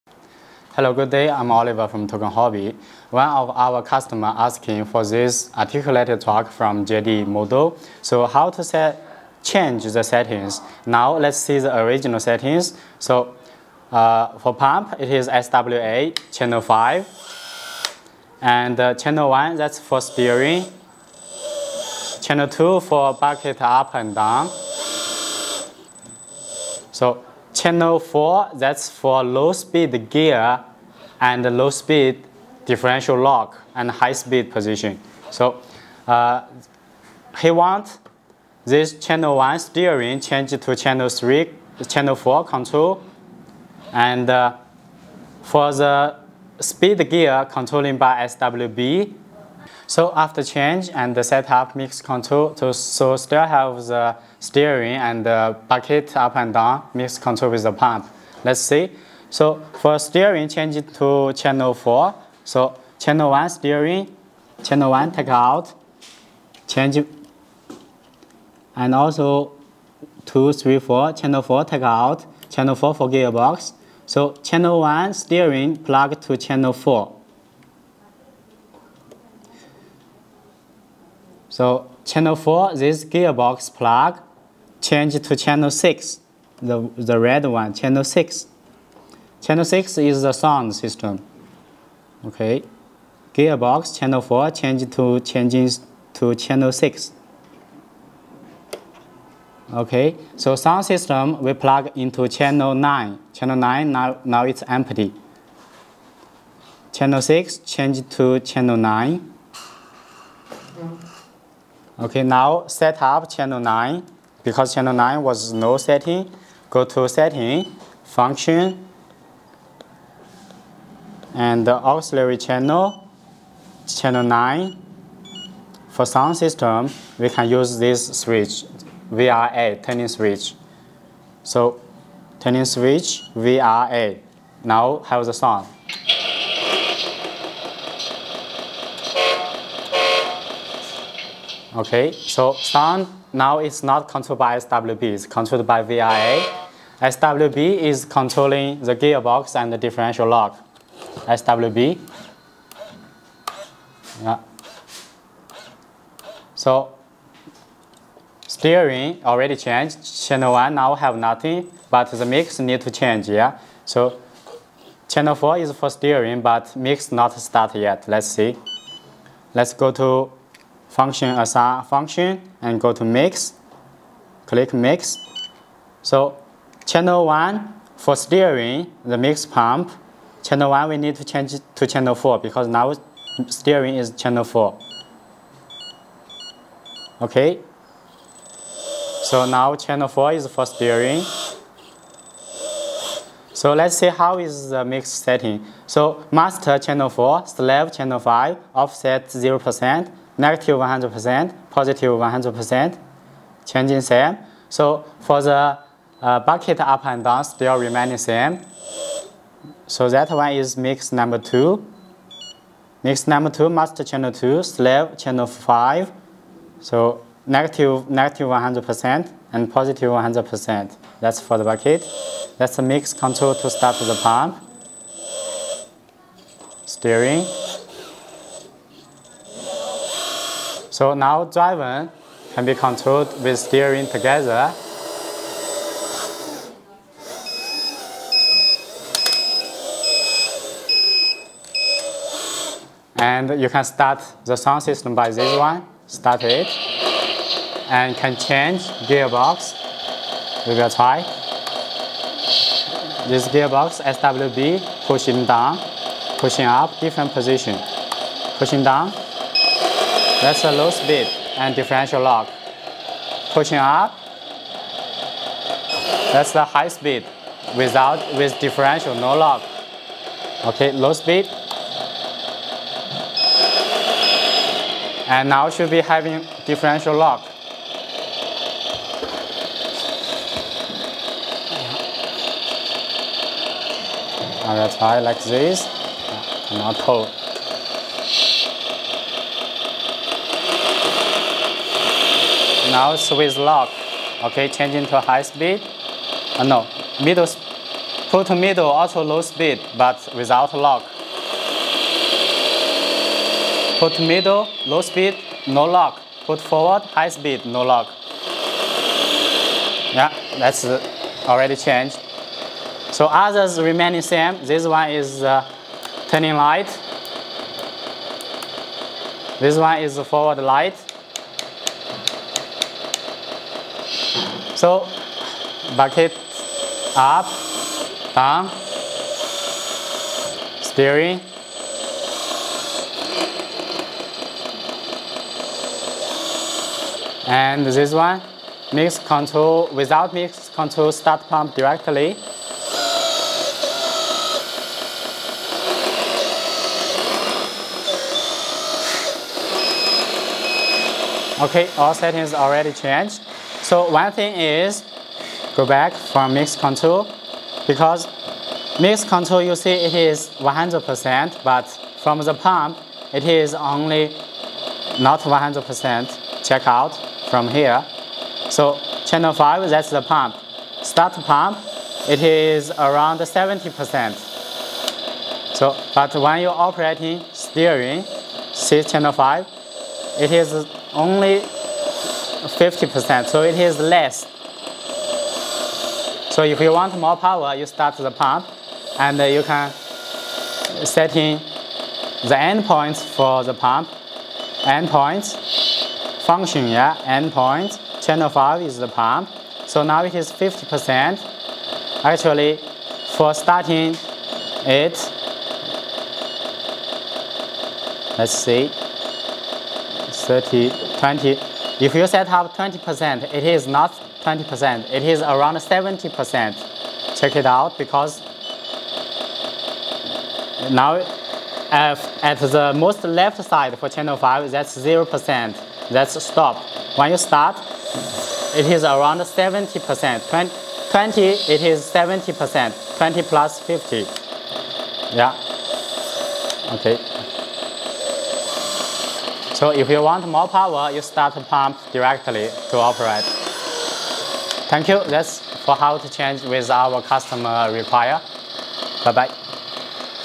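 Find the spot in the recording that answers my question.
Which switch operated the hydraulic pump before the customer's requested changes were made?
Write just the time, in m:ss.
0:15.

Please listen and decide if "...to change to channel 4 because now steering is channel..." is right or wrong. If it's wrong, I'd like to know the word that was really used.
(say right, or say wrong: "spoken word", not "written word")
right.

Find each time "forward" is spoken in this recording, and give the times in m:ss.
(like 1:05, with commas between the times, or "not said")
5:06, 5:20.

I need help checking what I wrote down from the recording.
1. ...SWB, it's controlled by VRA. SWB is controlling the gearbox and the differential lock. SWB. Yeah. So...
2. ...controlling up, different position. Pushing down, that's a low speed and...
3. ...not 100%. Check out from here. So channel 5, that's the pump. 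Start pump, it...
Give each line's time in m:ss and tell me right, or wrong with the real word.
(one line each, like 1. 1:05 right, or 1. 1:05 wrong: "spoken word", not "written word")
1. 2:24 right
2. 4:16 wrong: "pushing", not "controlling"
3. 6:05 right.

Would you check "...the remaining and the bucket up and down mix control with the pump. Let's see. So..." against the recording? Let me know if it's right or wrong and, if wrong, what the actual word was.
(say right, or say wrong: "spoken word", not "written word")
wrong: "steering", not "remaining".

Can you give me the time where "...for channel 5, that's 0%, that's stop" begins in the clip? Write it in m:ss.
7:03.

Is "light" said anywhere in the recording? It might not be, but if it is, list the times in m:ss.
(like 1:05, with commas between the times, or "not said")
5:16, 5:20.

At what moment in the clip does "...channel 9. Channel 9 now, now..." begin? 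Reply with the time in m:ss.
1:42.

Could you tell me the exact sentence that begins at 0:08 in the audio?
So how to set change the settings.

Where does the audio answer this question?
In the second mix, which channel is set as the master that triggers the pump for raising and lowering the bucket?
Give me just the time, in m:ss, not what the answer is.
3:33.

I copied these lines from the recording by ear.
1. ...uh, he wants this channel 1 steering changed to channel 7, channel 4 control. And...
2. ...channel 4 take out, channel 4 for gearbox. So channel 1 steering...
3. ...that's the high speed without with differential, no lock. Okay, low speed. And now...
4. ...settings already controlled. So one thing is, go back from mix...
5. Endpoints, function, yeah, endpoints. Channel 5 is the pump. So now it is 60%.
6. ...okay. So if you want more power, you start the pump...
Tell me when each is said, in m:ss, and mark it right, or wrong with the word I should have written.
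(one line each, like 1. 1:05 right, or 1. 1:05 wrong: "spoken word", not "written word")
1. 0:36 wrong: "3", not "7"
2. 1:11 right
3. 4:26 right
4. 5:52 wrong: "changed", not "controlled"
5. 6:34 wrong: "50", not "60"
6. 7:16 right.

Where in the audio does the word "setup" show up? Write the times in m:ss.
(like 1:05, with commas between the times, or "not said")
0:51.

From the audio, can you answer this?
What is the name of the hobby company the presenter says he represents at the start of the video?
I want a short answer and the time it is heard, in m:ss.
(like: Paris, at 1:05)
Toucan Hobby, at 0:02.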